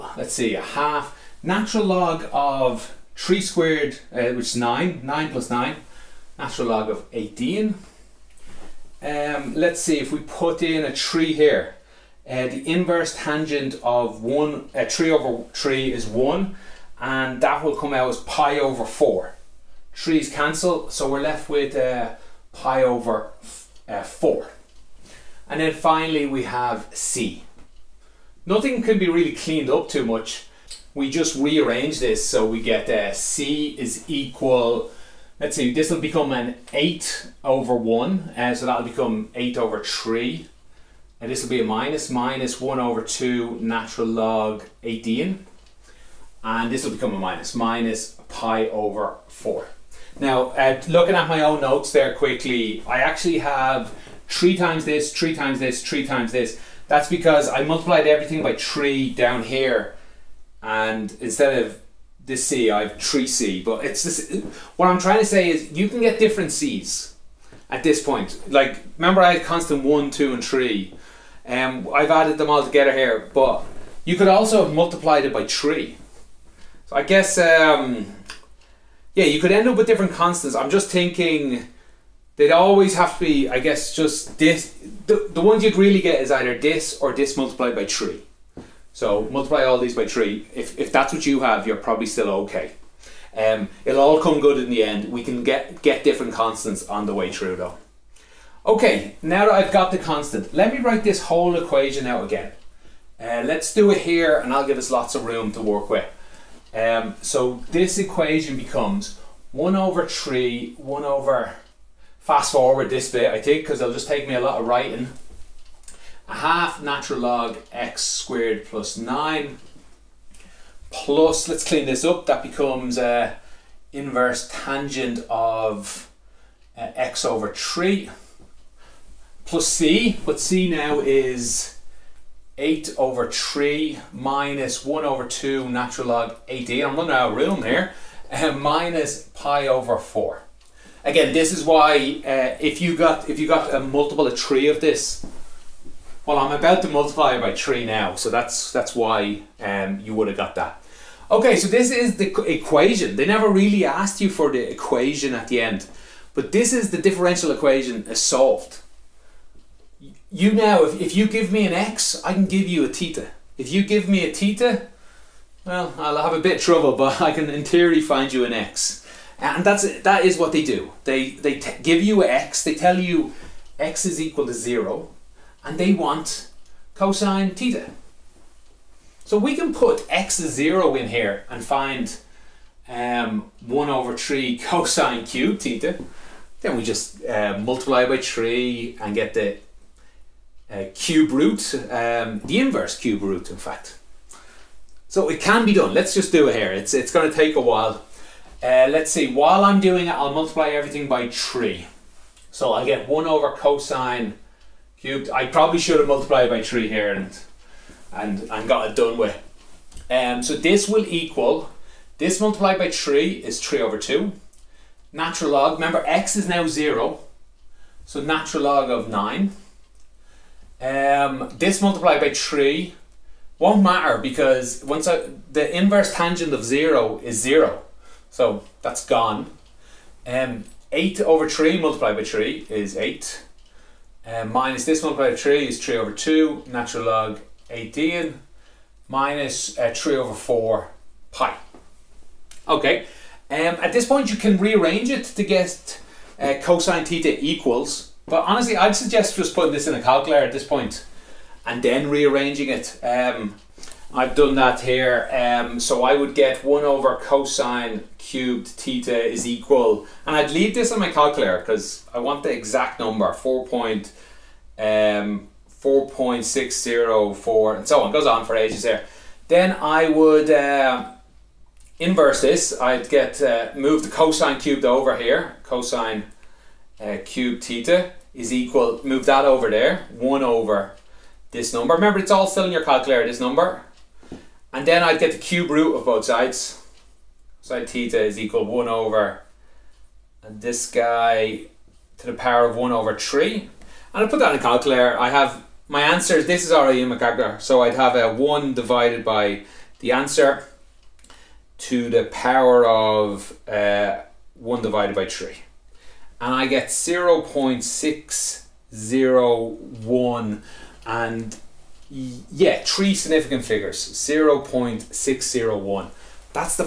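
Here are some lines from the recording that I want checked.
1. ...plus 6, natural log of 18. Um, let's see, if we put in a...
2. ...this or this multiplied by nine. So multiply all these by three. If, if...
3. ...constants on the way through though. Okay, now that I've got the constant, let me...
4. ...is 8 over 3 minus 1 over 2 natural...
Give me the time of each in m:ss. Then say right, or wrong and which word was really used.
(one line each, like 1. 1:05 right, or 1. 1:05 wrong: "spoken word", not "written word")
1. 0:05 wrong: "9", not "6"
2. 1:26 wrong: "three", not "nine"
3. 1:36 right
4. 2:10 right.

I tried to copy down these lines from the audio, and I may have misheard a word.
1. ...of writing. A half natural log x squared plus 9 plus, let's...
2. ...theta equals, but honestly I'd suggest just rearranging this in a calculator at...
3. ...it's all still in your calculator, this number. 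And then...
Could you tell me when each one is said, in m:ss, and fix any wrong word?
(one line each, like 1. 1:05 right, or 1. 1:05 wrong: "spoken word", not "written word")
1. 1:54 right
2. 4:07 wrong: "putting", not "rearranging"
3. 4:42 right.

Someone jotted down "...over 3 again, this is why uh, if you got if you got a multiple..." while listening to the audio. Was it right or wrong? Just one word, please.
wrong.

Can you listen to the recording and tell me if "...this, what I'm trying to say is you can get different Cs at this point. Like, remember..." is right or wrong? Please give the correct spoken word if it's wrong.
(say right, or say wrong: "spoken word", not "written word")
right.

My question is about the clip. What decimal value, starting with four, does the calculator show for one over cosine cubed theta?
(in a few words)
4.604.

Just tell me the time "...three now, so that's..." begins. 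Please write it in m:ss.
2:27.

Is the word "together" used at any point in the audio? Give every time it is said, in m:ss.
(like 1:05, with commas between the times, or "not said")
1:12.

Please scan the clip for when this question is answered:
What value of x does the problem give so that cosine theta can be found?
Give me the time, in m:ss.
2:53.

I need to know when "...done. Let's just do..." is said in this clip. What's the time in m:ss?
3:15.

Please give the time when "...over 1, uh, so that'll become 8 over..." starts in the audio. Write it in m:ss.
0:37.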